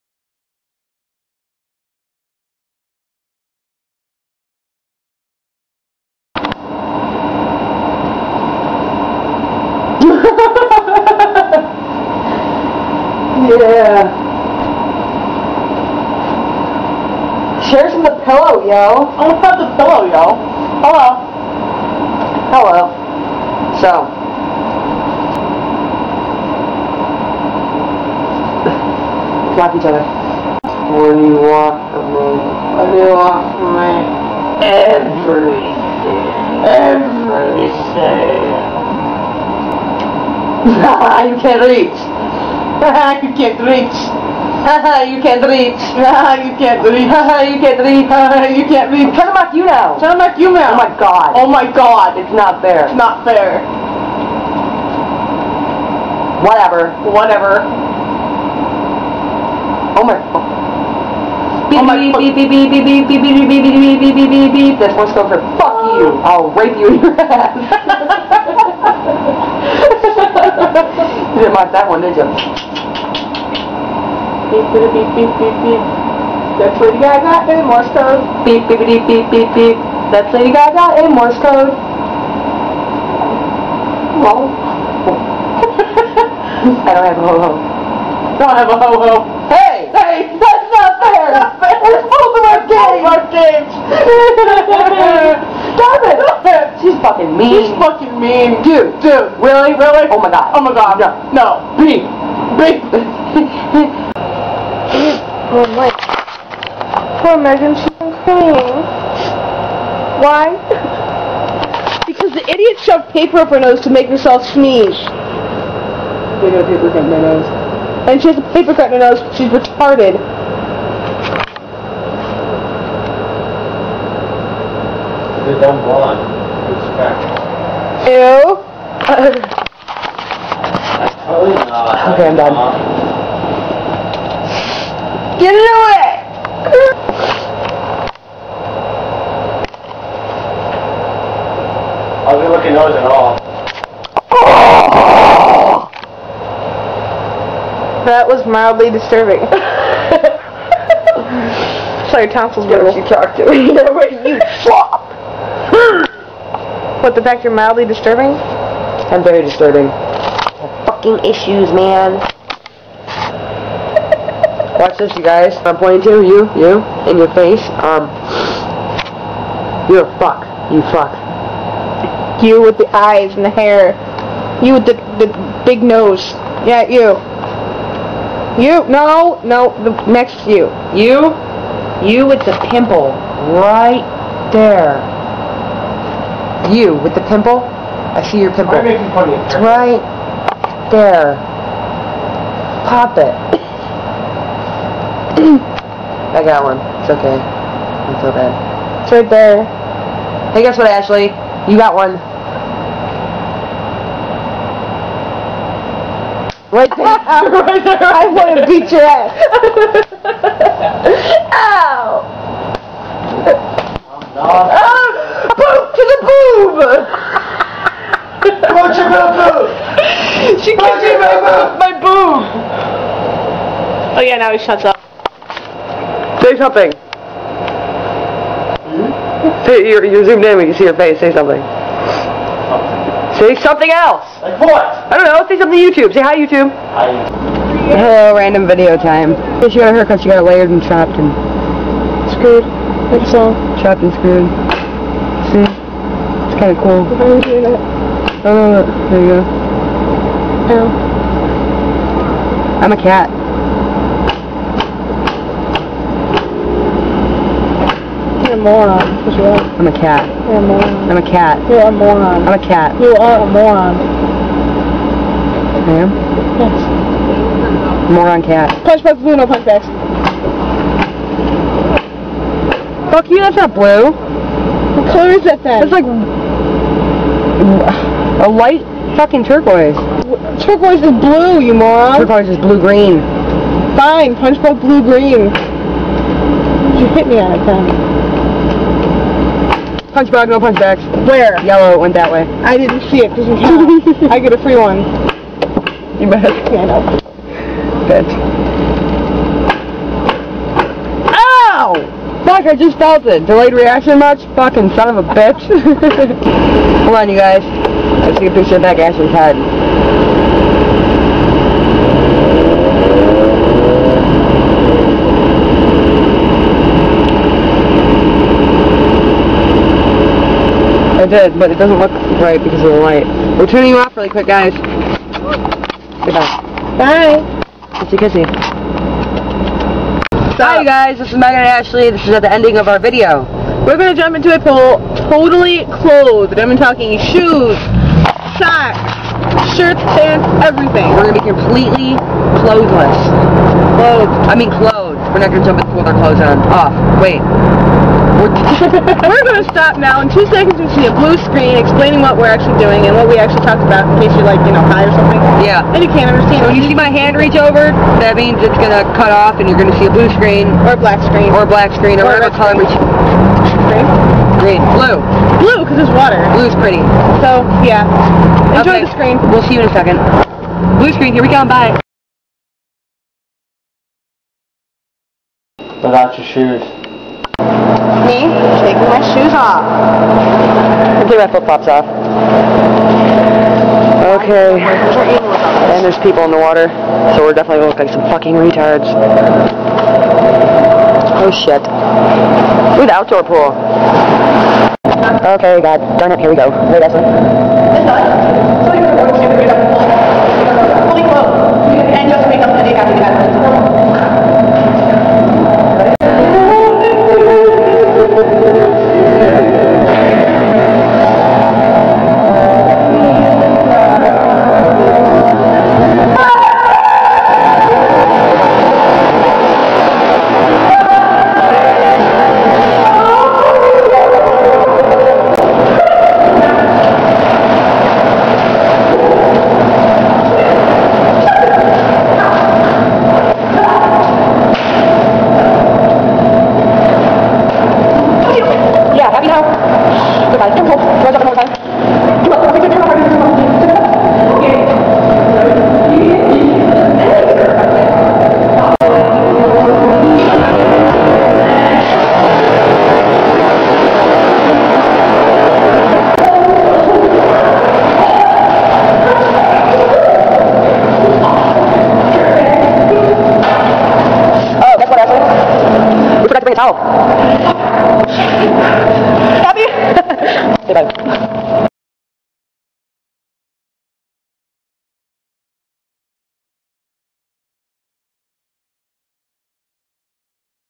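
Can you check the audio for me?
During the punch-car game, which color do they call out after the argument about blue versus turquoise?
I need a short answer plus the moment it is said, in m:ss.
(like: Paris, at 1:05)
Yellow, at 4:51.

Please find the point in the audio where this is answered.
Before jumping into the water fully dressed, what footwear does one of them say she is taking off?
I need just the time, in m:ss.
6:21.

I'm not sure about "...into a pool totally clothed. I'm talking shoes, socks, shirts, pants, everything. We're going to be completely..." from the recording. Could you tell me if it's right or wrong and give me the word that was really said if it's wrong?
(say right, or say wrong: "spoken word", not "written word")
right.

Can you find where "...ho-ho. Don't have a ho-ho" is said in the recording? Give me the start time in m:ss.
1:27.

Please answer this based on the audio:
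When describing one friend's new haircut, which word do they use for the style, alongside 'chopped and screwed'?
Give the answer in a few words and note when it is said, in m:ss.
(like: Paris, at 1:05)
Layered, at 4:00.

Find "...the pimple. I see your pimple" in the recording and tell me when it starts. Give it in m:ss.
3:07.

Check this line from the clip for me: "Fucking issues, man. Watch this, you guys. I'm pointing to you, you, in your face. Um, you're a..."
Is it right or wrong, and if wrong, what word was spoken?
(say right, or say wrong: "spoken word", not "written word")
right.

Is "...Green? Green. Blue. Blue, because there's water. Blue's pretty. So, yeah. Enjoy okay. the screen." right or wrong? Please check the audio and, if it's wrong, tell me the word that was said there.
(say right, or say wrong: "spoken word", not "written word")
right.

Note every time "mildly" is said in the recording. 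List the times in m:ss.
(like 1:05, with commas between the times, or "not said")
2:28, 2:37.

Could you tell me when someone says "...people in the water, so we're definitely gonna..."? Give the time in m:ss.
6:26.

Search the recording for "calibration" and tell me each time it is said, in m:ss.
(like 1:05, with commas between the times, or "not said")
not said.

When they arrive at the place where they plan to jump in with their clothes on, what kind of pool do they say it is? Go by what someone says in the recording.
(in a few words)
Outdoor pool.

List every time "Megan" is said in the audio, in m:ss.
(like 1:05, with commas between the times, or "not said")
1:47, 5:31.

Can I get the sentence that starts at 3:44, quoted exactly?
Oh yeah, now he shuts up.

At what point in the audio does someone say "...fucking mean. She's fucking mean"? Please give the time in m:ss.
1:37.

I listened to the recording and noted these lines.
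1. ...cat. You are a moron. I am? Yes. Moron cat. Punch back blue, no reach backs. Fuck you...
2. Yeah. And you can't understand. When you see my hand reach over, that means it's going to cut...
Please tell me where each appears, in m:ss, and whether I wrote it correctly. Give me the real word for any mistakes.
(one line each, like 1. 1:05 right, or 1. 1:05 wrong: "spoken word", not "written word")
1. 4:22 wrong: "punch", not "reach"
2. 5:55 right.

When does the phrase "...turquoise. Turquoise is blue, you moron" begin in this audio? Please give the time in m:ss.
4:39.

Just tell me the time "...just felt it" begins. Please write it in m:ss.
5:02.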